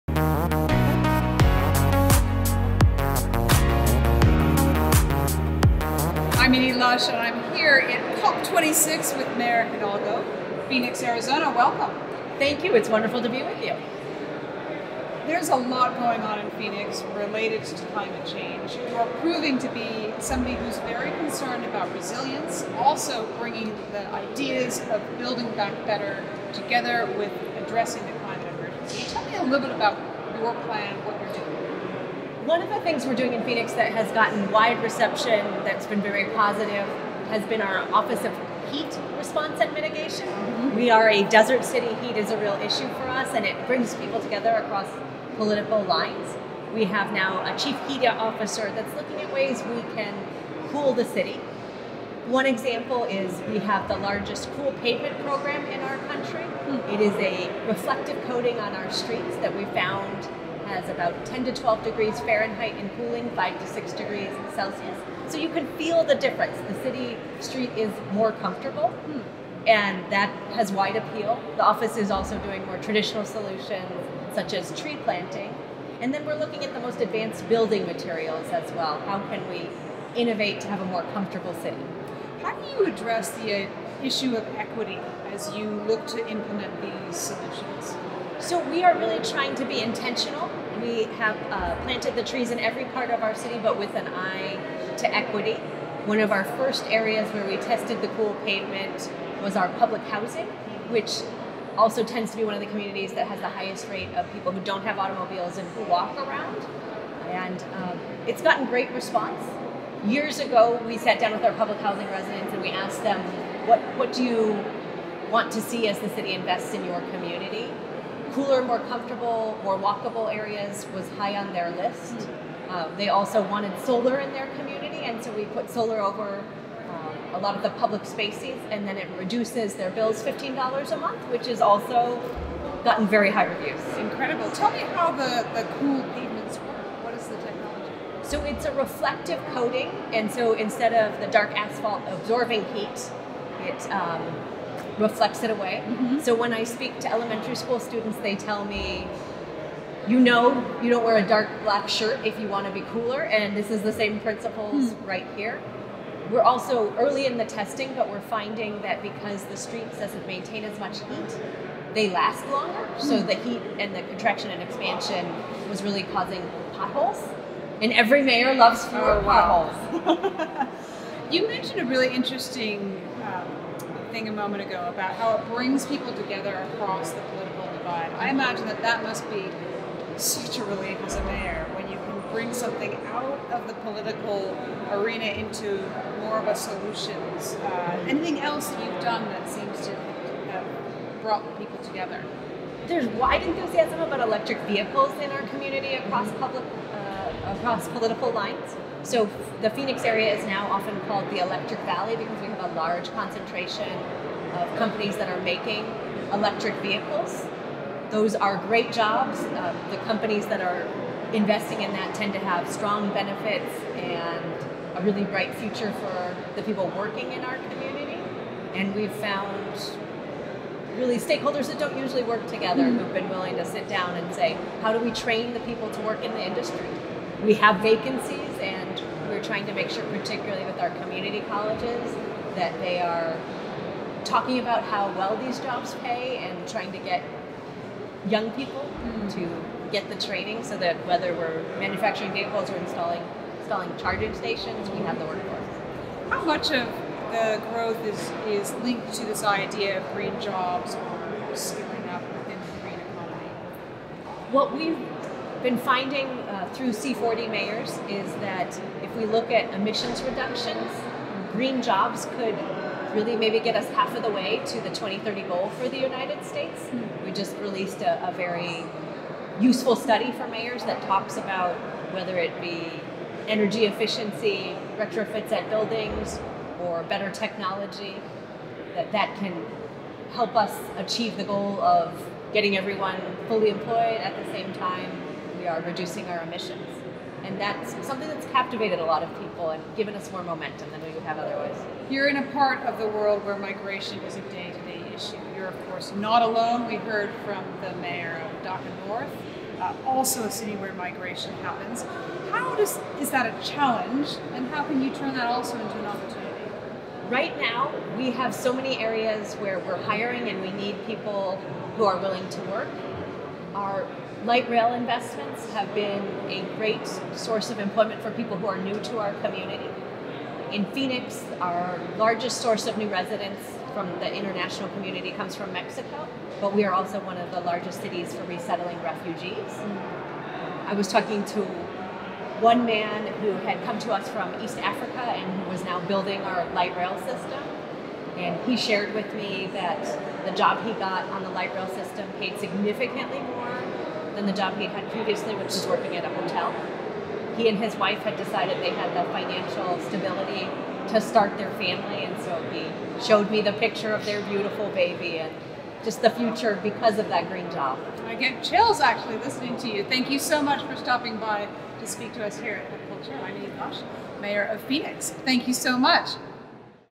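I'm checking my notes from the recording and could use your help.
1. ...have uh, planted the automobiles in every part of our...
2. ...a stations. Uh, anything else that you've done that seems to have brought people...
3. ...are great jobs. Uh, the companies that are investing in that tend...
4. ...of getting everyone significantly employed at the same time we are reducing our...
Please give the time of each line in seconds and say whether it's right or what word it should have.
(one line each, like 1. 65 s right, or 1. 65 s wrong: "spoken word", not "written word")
1. 91 s wrong: "trees", not "automobiles"
2. 186 s wrong: "solutions", not "stations"
3. 208 s right
4. 281 s wrong: "fully", not "significantly".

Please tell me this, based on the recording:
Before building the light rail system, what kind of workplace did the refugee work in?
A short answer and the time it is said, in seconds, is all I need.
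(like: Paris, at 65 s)
A hotel, at 346 s.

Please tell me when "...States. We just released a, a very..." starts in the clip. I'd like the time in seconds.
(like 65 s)
266 s.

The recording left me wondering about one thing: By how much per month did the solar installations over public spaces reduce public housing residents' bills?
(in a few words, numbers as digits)
$15.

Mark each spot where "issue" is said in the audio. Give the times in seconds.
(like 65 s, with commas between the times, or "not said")
42 s, 84 s, 295 s.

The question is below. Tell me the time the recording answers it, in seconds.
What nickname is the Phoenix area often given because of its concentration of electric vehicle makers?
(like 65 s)
201 s.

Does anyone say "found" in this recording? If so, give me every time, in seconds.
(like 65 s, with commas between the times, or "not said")
59 s, 219 s.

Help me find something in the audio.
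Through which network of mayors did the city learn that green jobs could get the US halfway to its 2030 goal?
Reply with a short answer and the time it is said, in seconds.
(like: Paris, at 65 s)
C40, at 256 s.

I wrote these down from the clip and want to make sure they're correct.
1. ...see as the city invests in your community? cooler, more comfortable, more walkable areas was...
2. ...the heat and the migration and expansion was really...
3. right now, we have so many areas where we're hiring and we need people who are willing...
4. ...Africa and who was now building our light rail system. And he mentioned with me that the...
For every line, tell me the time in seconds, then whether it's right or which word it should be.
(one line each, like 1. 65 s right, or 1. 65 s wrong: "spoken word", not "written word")
1. 115 s right
2. 163 s wrong: "contraction", not "migration"
3. 307 s right
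4. 334 s wrong: "shared", not "mentioned".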